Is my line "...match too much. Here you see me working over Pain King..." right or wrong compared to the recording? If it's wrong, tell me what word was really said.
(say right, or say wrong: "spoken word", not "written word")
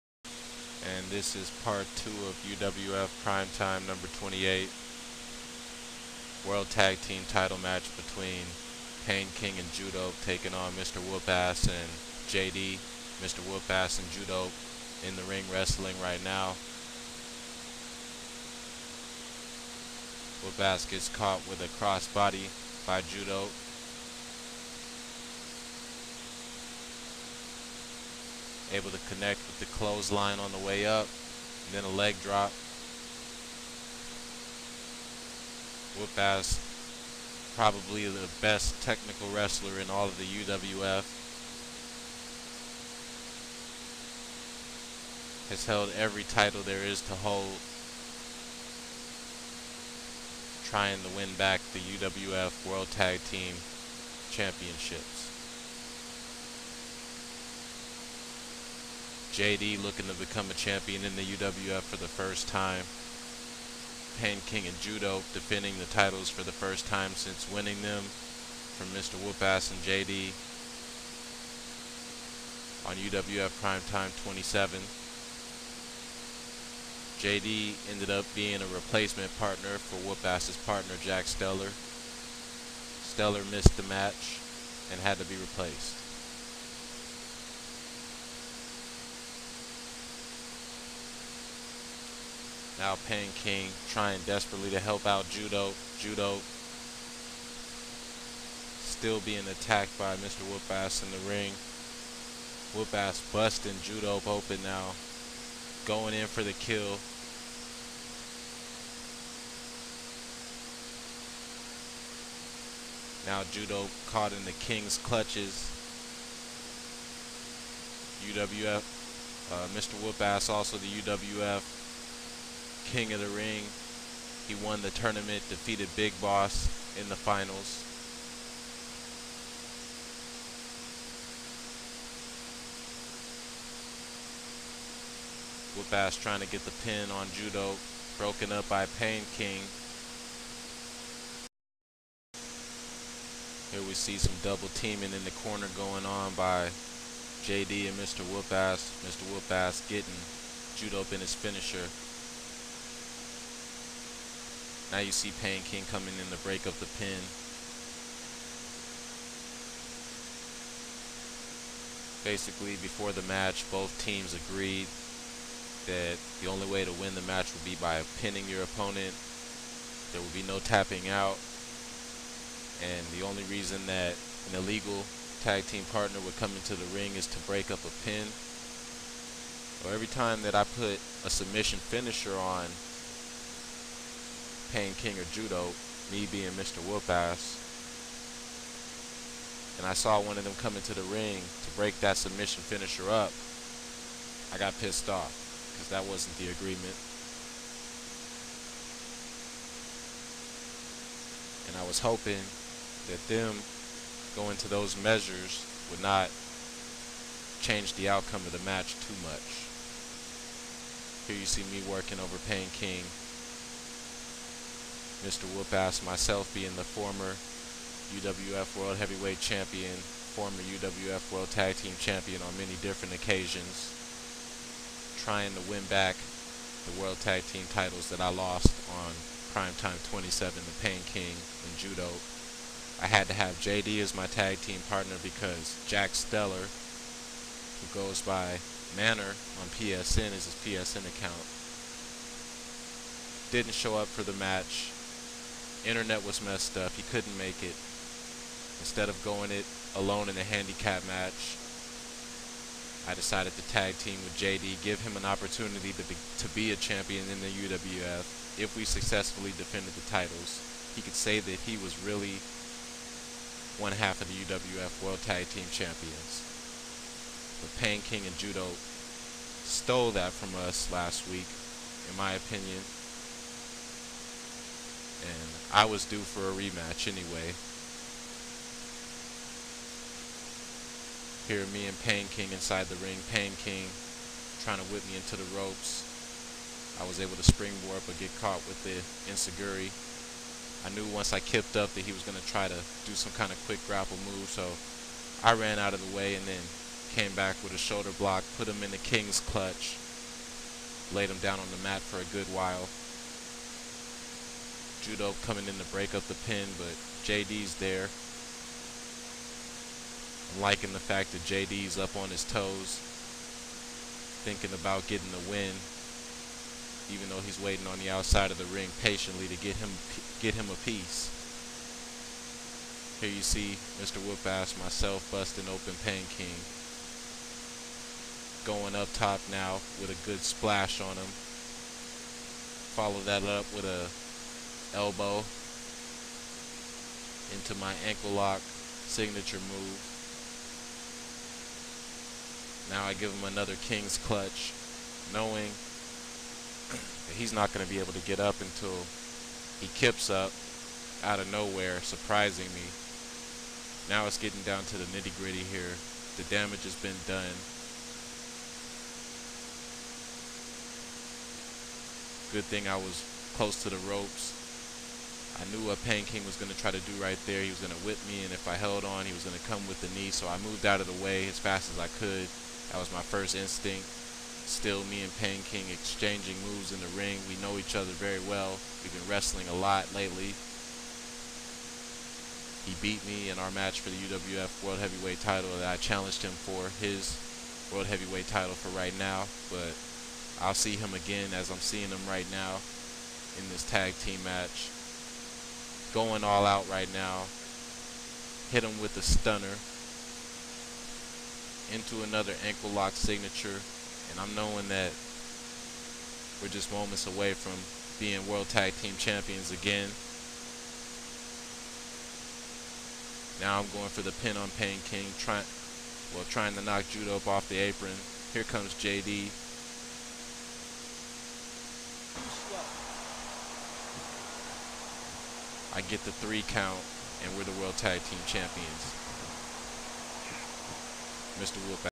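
right.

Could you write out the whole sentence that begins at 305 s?
Judo coming in to break up the pin, but JD's there.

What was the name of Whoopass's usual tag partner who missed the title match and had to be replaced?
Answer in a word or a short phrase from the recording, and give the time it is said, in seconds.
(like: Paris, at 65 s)
Jack Stellar, at 81 s.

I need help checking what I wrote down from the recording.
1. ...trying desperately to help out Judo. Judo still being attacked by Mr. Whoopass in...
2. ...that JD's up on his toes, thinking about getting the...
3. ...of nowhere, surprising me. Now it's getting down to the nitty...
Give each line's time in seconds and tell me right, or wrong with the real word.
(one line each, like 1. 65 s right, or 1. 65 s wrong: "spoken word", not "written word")
1. 93 s right
2. 311 s right
3. 351 s right.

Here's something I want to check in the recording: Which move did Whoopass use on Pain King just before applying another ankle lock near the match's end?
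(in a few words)
Stunner.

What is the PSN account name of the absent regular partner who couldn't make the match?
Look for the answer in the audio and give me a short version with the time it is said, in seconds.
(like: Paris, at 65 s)
Manor, at 238 s.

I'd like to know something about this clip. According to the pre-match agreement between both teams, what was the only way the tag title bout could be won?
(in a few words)
Pinning your opponent.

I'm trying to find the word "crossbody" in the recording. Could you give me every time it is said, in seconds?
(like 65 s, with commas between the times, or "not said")
21 s.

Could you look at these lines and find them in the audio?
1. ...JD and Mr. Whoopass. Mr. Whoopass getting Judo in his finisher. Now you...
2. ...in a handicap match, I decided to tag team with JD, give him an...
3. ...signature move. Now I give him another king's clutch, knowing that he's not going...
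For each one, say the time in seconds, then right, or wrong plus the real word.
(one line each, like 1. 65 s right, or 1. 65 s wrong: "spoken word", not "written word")
1. 147 s right
2. 250 s right
3. 338 s right.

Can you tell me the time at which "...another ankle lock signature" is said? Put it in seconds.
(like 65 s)
402 s.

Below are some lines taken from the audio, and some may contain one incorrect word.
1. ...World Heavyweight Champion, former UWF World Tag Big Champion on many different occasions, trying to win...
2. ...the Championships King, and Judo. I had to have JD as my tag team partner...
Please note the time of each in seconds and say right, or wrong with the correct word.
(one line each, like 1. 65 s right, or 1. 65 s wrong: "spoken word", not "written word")
1. 218 s wrong: "Team", not "Big"
2. 230 s wrong: "Pain", not "Championships".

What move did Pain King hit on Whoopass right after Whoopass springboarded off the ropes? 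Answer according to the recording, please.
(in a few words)
Enzuigiri.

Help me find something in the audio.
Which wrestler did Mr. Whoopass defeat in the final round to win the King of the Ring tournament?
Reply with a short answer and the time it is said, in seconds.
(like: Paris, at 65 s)
Big Boss, at 125 s.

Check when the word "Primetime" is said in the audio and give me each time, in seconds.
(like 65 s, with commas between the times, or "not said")
3 s, 73 s, 229 s.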